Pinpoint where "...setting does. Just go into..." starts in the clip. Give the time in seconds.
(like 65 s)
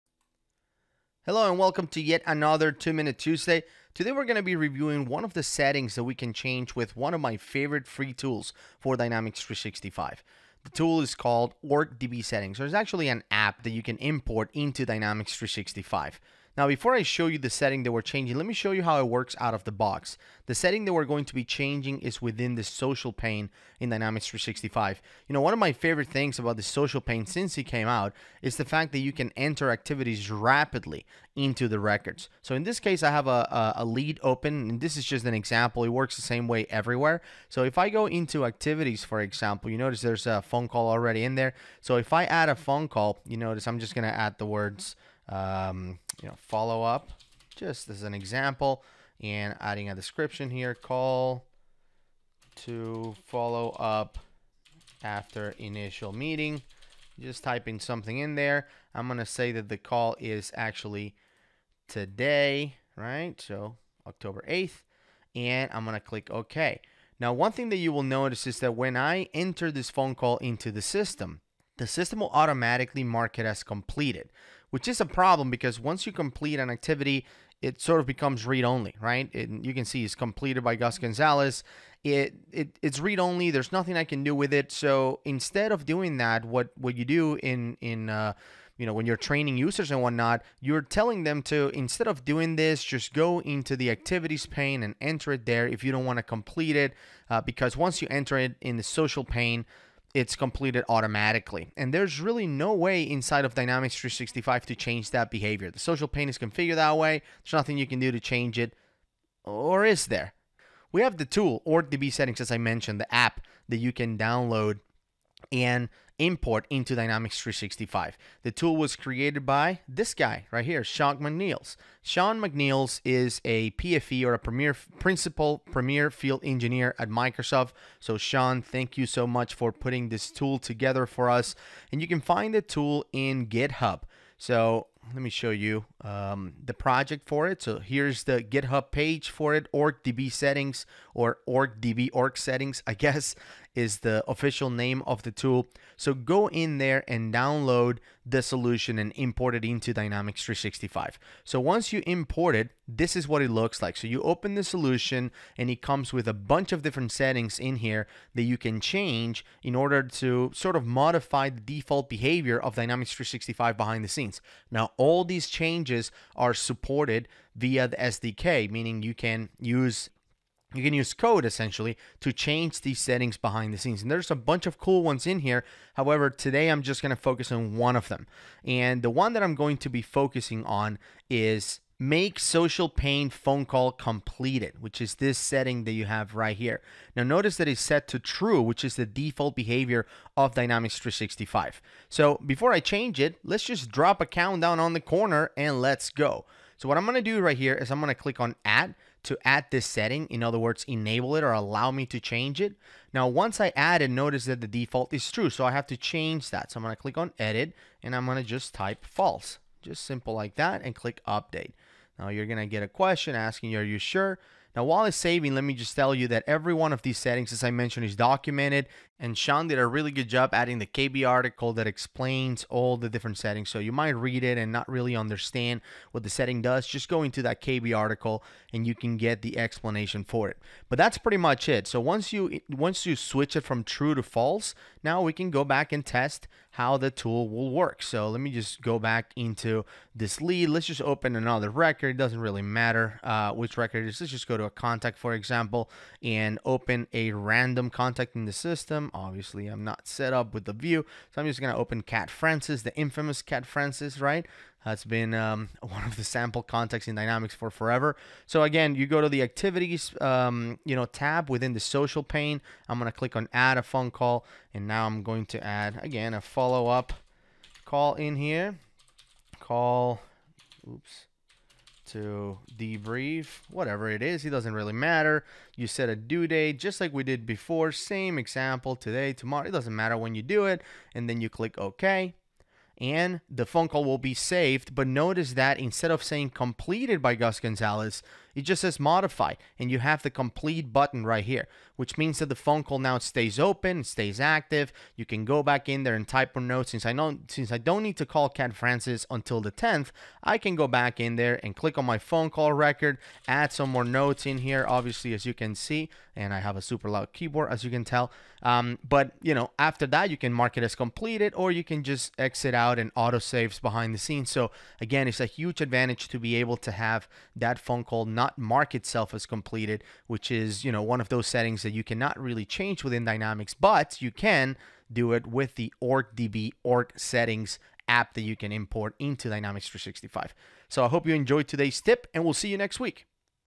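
226 s.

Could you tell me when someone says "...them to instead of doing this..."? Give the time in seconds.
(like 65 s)
91 s.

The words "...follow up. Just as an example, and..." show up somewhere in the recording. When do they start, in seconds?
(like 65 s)
46 s.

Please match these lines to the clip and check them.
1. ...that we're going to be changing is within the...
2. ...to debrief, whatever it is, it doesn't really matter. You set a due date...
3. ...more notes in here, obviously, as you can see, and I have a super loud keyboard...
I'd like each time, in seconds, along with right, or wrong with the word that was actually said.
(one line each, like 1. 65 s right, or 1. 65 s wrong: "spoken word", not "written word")
1. 20 s right
2. 272 s right
3. 303 s right.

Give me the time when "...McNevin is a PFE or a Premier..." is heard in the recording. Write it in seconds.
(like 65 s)
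122 s.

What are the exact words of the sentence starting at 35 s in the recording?
It works the same way everywhere.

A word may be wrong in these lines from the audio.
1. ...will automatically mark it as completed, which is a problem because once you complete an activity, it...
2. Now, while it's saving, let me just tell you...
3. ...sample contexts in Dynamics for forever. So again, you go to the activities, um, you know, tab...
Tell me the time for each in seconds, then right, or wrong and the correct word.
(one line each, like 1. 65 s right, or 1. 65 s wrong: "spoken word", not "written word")
1. 72 s right
2. 214 s right
3. 256 s right.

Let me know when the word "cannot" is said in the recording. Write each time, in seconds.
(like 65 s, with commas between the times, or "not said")
322 s.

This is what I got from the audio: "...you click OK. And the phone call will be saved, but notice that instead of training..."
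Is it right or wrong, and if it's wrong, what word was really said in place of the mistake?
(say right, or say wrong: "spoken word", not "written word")
wrong: "saying", not "training".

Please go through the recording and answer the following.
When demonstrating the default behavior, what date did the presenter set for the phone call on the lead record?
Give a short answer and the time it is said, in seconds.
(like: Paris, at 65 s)
October 8th, at 64 s.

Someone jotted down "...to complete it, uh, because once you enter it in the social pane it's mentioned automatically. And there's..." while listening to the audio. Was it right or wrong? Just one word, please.
wrong.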